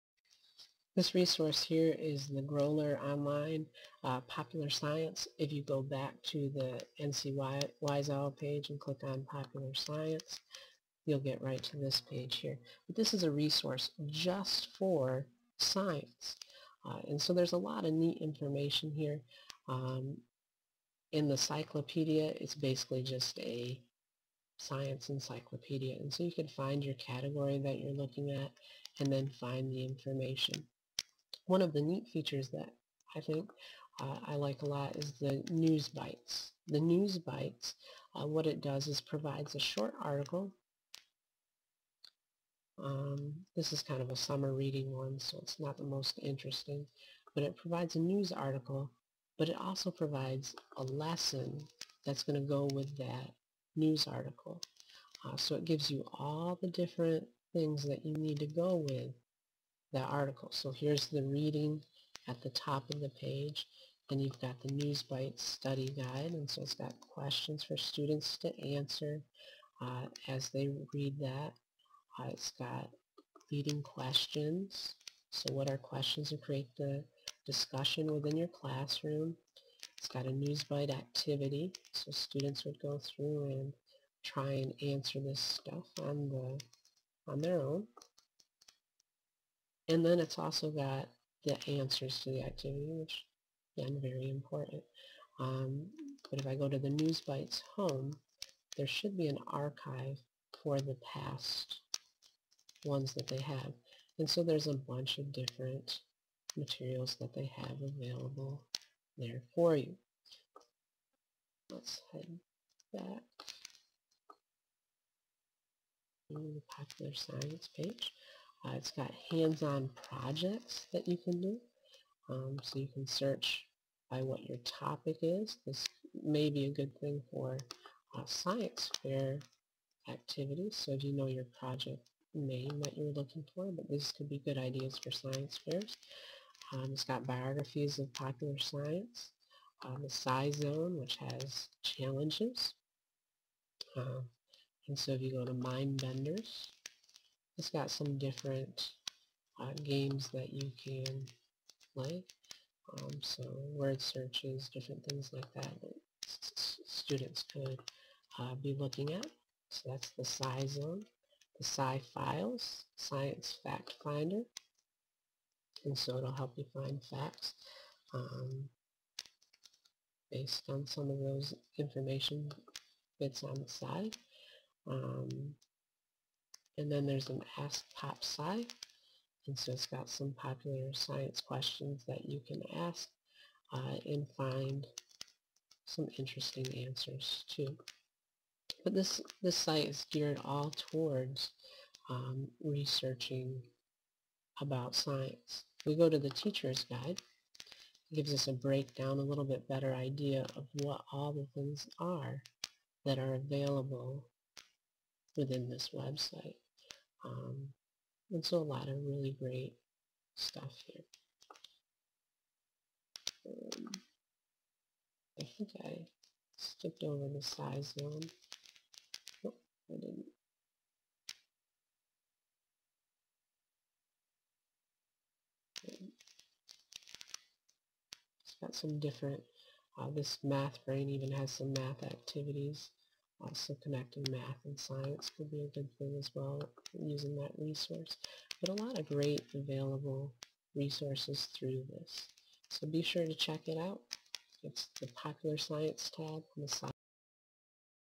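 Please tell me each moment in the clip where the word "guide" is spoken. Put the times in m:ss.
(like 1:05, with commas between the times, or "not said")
1:05, 3:16.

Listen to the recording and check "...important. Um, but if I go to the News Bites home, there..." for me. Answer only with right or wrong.
right.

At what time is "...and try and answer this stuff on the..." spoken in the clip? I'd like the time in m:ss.
1:23.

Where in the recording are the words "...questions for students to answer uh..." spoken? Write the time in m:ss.
1:06.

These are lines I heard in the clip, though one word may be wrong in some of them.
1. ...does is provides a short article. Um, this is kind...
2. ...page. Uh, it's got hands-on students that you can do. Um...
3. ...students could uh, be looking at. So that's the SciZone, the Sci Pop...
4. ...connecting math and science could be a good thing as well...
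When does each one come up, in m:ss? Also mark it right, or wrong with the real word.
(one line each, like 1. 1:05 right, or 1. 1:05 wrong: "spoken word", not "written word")
1. 0:38 right
2. 1:57 wrong: "projects", not "students"
3. 2:36 wrong: "Files", not "Pop"
4. 3:53 right.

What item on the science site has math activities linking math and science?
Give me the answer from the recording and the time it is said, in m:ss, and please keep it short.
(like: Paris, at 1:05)
math brain, at 3:50.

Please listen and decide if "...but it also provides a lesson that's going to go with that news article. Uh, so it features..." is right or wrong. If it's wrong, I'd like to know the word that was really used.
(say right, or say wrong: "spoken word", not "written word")
wrong: "gives", not "features".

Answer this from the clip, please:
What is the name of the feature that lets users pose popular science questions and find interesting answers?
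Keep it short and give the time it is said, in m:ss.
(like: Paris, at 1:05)
Ask Pop Sci, at 2:57.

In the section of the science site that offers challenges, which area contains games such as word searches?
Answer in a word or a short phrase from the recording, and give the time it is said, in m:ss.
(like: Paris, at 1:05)
Mind Benders, at 2:25.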